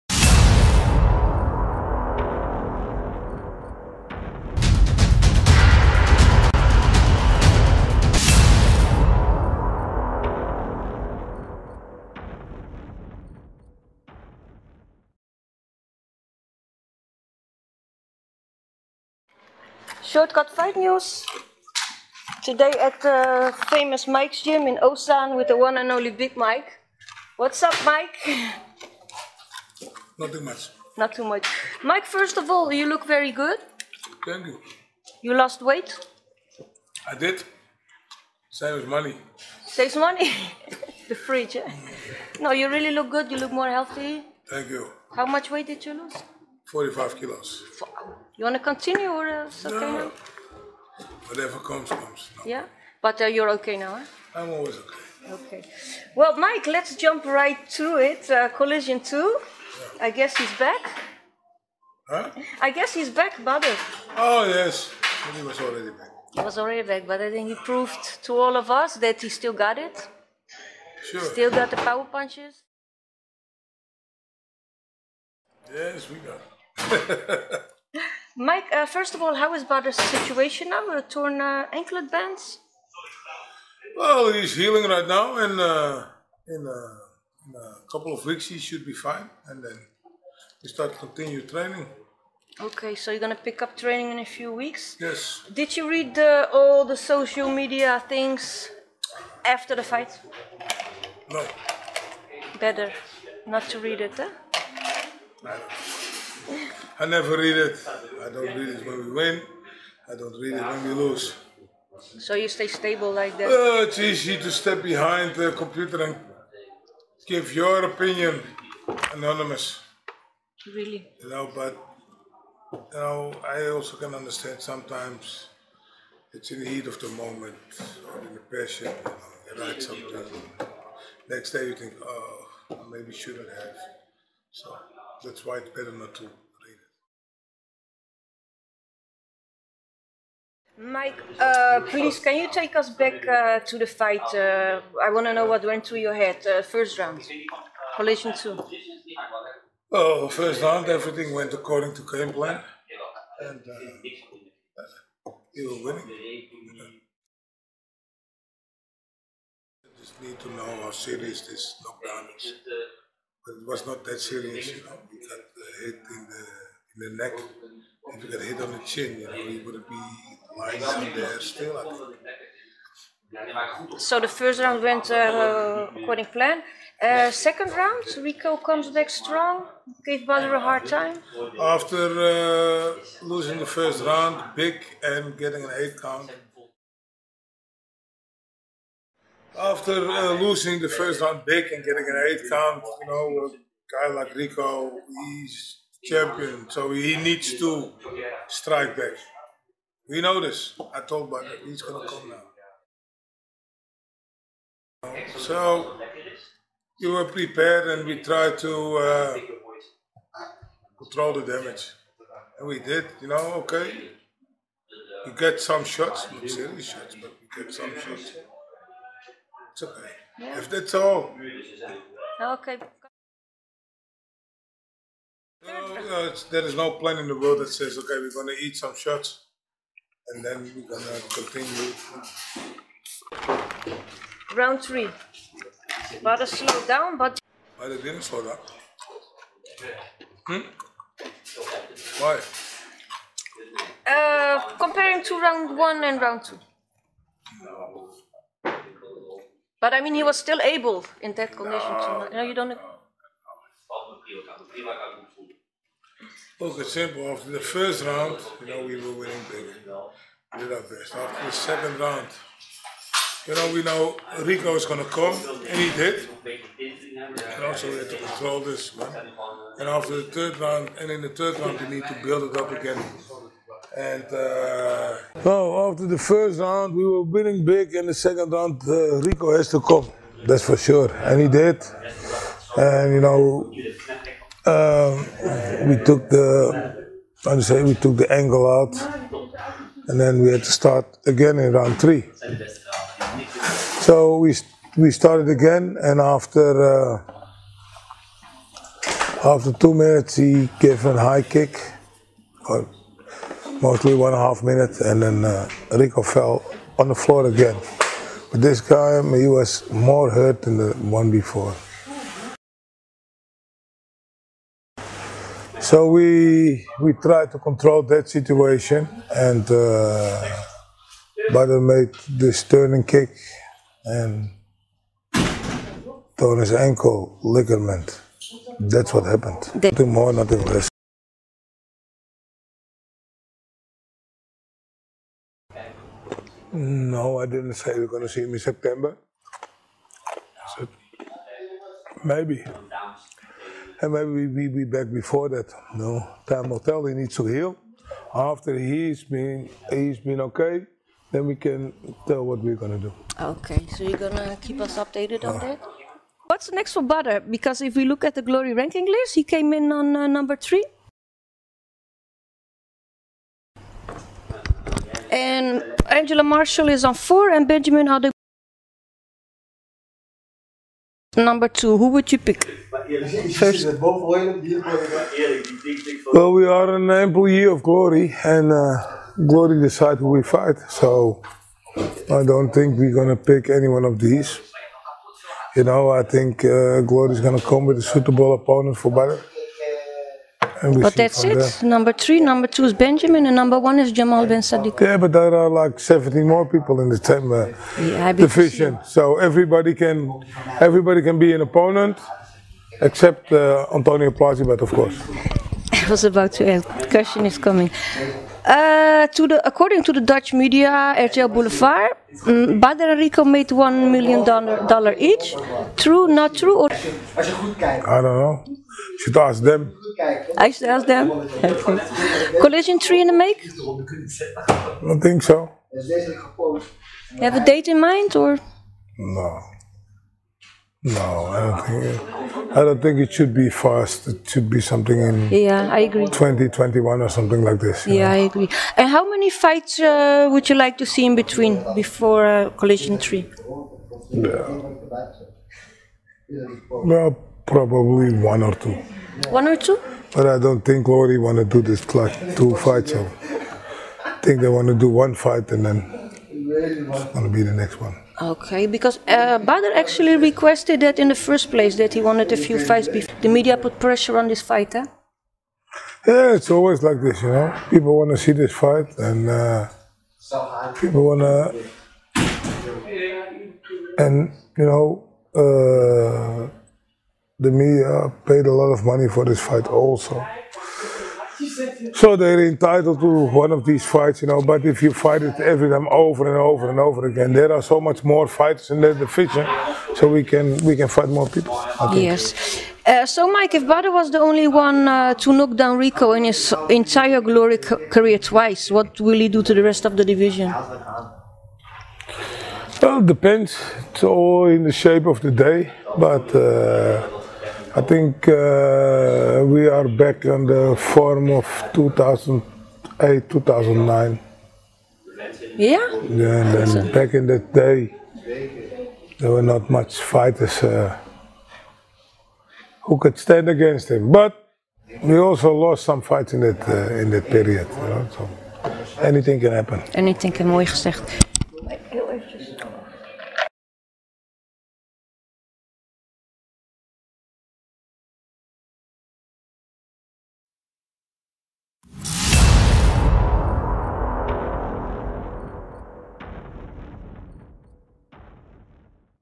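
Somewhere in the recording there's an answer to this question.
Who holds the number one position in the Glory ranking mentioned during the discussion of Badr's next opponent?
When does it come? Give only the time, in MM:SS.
06:34.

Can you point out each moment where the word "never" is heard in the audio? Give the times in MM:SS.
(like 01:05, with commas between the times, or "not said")
01:47.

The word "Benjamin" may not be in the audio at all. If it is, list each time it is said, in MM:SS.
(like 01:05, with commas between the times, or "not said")
06:07, 06:32.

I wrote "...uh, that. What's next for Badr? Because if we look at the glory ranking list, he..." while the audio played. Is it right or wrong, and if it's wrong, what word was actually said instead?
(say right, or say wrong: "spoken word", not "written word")
right.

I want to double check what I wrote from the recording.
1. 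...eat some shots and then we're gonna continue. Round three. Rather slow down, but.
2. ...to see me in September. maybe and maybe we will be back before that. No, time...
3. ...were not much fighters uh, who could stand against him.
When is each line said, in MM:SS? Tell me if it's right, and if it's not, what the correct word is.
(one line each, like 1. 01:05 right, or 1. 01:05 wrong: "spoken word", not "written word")
1. 03:48 right
2. 05:38 right
3. 08:39 right.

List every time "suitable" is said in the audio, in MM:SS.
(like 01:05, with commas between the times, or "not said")
06:28.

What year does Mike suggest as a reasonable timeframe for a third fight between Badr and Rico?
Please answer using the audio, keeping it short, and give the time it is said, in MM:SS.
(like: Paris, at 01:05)
2021, at 07:16.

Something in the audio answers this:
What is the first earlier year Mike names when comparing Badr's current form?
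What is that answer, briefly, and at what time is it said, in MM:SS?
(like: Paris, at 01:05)
2008, at 08:31.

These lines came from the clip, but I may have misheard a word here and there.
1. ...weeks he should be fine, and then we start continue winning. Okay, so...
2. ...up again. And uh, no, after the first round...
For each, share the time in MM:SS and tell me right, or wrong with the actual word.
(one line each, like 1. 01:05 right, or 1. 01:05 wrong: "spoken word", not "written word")
1. 01:28 wrong: "training", not "winning"
2. 04:32 right.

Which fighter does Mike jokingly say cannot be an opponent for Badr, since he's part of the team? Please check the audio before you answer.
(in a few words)
Antonio Plazibat.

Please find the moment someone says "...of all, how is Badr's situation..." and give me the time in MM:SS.
01:19.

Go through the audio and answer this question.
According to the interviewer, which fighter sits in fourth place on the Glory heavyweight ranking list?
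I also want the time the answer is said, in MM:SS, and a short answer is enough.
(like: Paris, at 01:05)
Angela Marshall, at 06:06.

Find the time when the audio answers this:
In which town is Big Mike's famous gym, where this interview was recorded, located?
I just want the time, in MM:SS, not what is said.
00:24.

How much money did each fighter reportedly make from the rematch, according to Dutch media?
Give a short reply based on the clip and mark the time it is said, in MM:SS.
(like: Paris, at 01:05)
$1 million, at 06:53.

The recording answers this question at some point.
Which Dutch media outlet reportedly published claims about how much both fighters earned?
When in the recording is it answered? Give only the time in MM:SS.
06:51.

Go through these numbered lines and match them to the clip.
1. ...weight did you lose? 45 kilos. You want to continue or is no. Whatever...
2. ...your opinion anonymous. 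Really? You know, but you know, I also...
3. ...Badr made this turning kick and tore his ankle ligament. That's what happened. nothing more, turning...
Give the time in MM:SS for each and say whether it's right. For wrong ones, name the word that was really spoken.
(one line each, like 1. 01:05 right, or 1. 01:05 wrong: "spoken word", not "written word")
1. 00:45 right
2. 01:57 right
3. 05:21 wrong: "nothing", not "turning".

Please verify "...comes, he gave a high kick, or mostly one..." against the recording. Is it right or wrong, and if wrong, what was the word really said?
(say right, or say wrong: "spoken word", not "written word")
wrong: "minutes", not "comes".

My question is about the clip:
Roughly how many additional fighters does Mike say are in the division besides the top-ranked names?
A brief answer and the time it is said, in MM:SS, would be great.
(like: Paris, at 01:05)
17, at 06:35.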